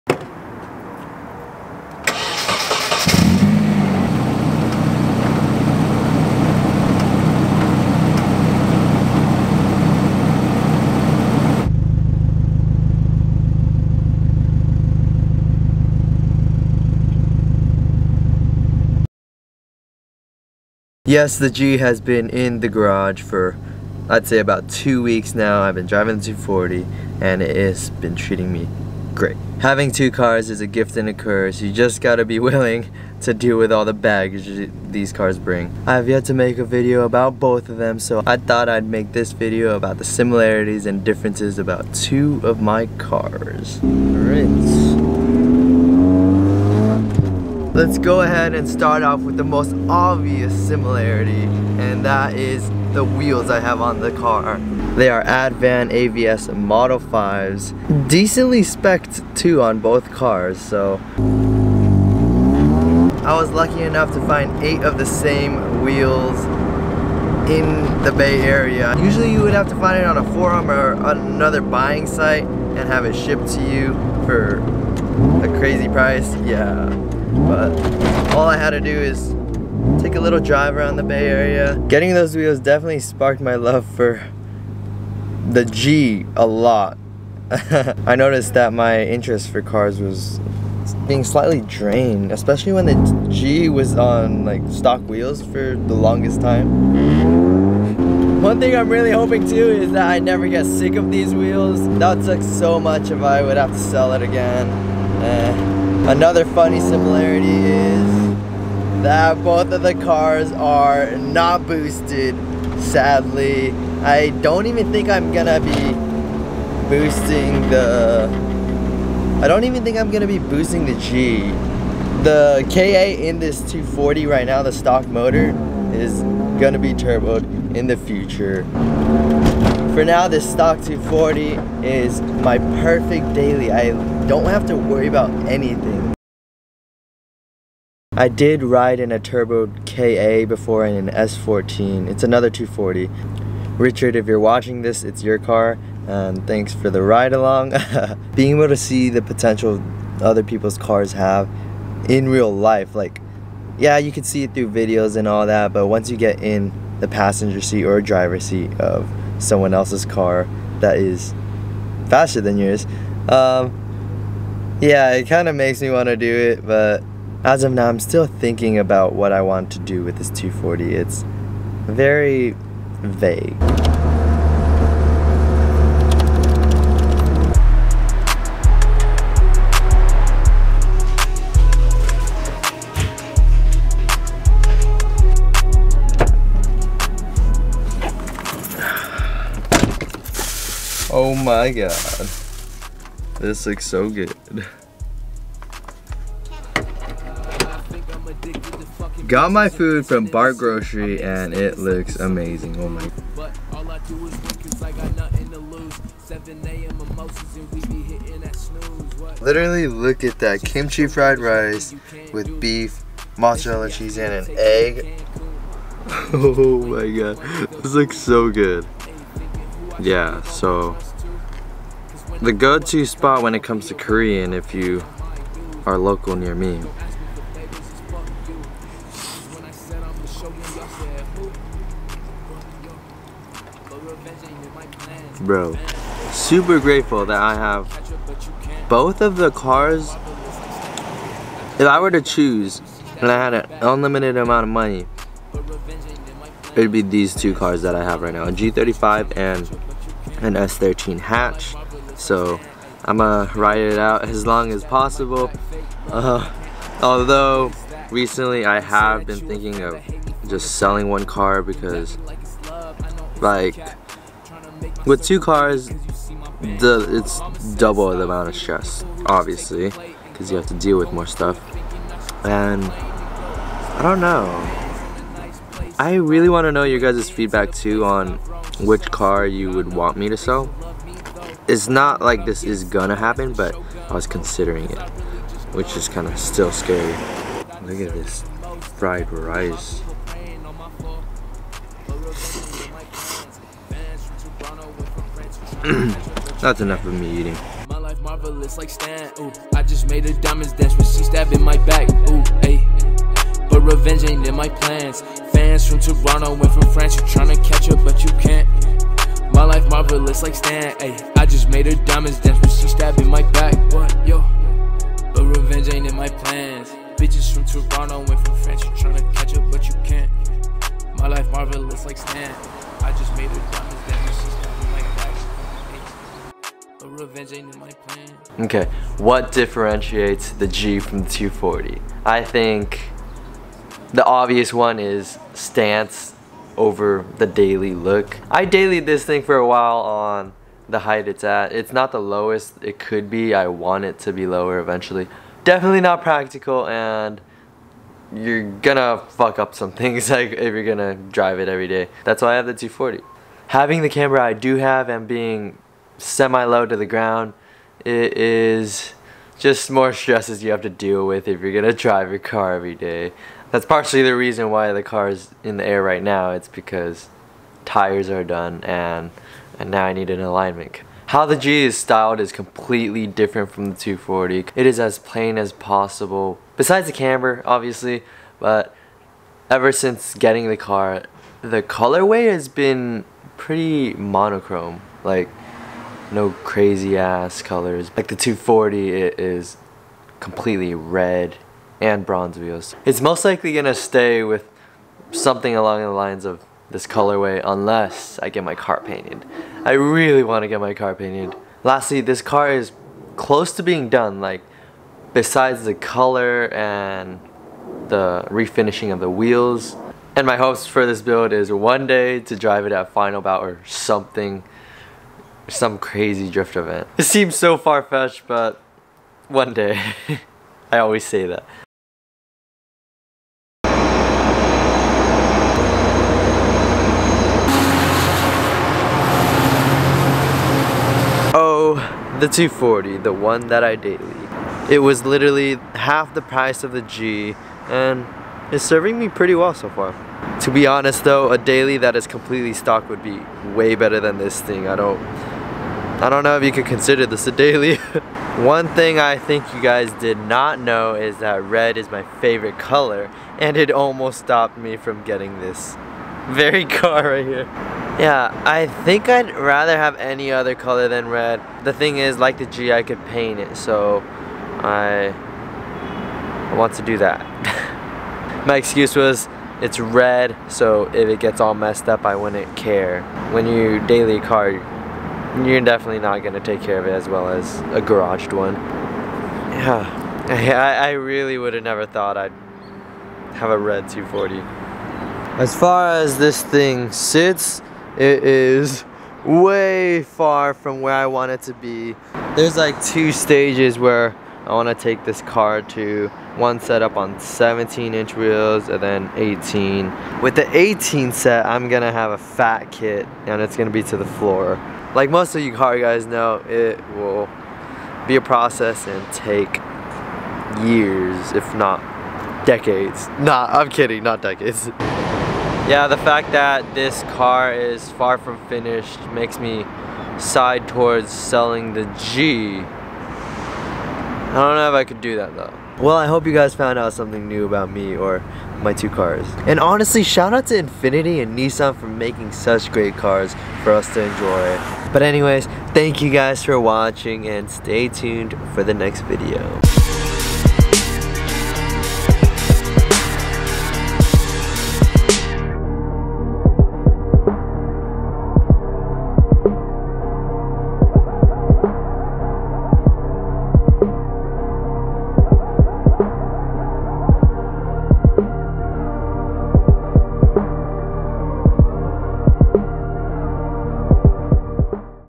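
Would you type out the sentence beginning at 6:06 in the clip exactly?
It's because tires are done and and now I need an alignment.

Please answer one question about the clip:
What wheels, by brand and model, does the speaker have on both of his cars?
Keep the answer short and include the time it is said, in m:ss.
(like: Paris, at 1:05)
Advan AVS Model 5, at 0:55.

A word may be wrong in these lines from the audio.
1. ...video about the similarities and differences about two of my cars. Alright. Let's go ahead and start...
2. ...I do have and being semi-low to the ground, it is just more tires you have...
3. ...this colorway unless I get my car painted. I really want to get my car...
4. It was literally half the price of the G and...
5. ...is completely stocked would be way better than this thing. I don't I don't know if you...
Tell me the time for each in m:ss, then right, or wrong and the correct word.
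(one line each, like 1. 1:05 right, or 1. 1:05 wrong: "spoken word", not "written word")
1. 0:39 right
2. 5:54 wrong: "stresses", not "tires"
3. 6:36 right
4. 7:14 right
5. 7:22 right.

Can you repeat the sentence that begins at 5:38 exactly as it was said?
I dailied this thing for a while on the height it's at.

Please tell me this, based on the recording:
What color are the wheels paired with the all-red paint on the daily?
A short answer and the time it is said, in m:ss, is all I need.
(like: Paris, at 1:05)
bronze, at 6:32.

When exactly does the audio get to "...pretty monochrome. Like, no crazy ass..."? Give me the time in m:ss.
6:23.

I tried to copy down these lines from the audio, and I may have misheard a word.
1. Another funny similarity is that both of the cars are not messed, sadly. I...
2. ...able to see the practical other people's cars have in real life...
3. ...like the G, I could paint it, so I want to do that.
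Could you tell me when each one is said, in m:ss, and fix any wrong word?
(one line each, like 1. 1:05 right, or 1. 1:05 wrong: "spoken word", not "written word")
1. 1:46 wrong: "boosted", not "messed"
2. 2:28 wrong: "potential", not "practical"
3. 7:42 right.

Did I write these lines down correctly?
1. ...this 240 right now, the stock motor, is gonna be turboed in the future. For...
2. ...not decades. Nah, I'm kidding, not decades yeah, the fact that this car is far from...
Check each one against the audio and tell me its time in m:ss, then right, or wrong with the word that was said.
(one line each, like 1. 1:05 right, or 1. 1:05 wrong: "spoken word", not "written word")
1. 2:03 right
2. 8:31 right.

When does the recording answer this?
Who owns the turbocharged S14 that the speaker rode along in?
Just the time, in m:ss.
2:23.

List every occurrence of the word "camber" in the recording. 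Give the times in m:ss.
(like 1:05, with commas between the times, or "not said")
5:54, 6:17.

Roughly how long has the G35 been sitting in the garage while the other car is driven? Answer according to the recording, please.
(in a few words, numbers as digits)
about two weeks.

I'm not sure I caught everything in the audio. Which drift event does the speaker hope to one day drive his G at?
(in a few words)
Final Bout.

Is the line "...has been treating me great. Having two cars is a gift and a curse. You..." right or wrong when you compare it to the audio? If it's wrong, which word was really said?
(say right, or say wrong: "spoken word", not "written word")
right.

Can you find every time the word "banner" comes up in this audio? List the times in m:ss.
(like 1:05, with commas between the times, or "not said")
not said.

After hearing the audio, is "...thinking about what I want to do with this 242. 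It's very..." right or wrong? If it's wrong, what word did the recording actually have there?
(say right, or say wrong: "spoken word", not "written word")
wrong: "240", not "242".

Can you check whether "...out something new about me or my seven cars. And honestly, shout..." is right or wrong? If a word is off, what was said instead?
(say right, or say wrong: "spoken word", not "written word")
wrong: "two", not "seven".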